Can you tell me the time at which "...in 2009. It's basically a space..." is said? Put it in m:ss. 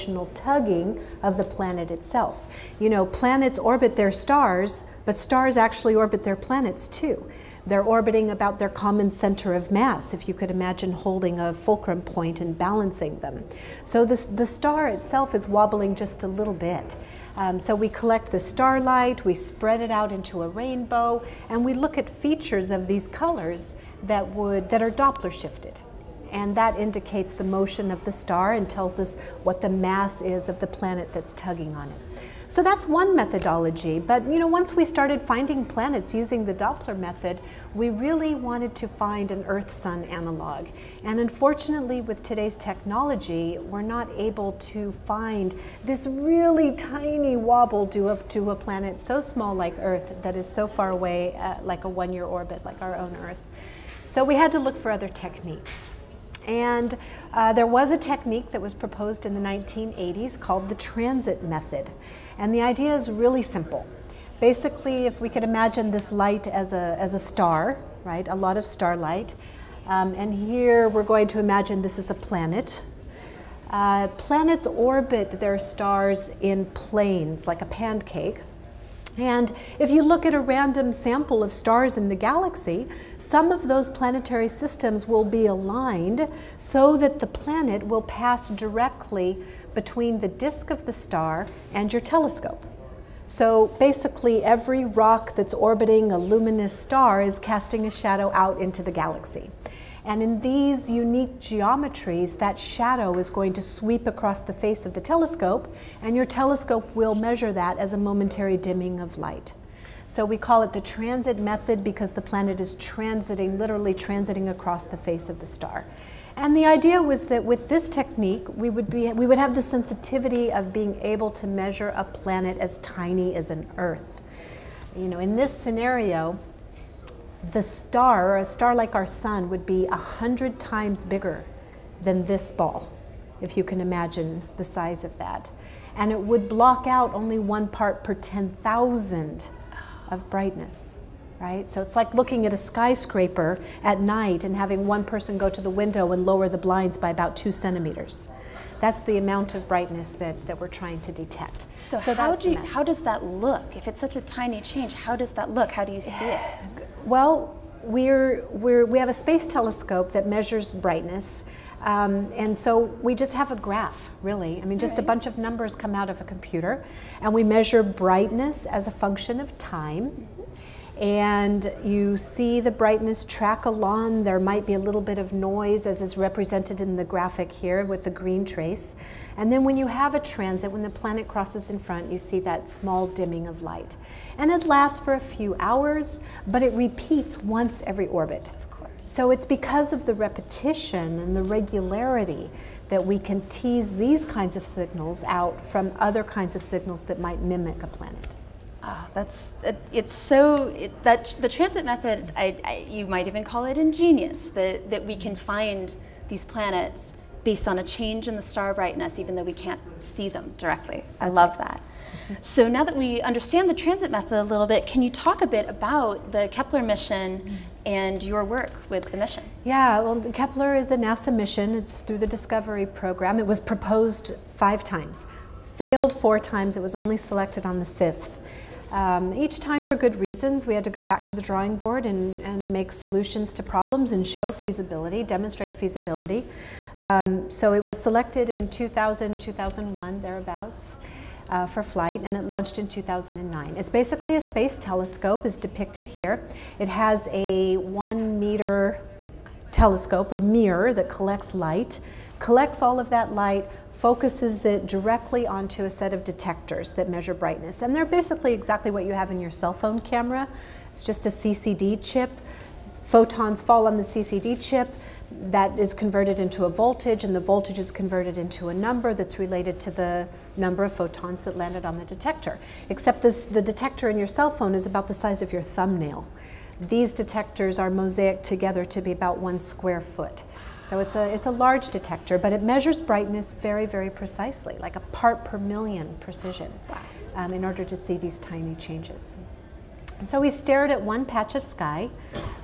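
4:02.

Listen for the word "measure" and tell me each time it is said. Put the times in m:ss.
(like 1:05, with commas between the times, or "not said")
1:47, 2:01, 2:40, 2:47, 4:17, 4:42.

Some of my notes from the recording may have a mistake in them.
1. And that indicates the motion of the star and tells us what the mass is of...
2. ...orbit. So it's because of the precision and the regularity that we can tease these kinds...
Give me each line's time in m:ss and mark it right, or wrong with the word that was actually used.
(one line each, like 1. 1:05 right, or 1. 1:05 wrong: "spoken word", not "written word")
1. 0:26 right
2. 3:08 wrong: "repetition", not "precision".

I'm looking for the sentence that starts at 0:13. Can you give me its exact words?
So this, the star itself is wobbling just a little bit.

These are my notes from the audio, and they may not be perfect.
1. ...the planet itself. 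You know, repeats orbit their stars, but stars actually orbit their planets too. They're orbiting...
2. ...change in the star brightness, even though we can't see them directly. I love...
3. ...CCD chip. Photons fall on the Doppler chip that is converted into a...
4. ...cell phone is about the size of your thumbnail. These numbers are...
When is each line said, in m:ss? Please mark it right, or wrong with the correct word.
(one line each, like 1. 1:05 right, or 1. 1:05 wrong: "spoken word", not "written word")
1. 0:01 wrong: "planets", not "repeats"
2. 3:27 right
3. 4:21 wrong: "CCD", not "Doppler"
4. 4:34 wrong: "detectors", not "numbers".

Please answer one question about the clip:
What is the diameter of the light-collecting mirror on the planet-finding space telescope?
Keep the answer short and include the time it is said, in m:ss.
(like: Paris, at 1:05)
1 meter, at 4:07.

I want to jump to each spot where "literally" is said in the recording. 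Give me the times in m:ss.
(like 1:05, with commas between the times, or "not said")
1:53.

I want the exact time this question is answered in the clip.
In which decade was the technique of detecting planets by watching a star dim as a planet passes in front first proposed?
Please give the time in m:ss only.
0:59.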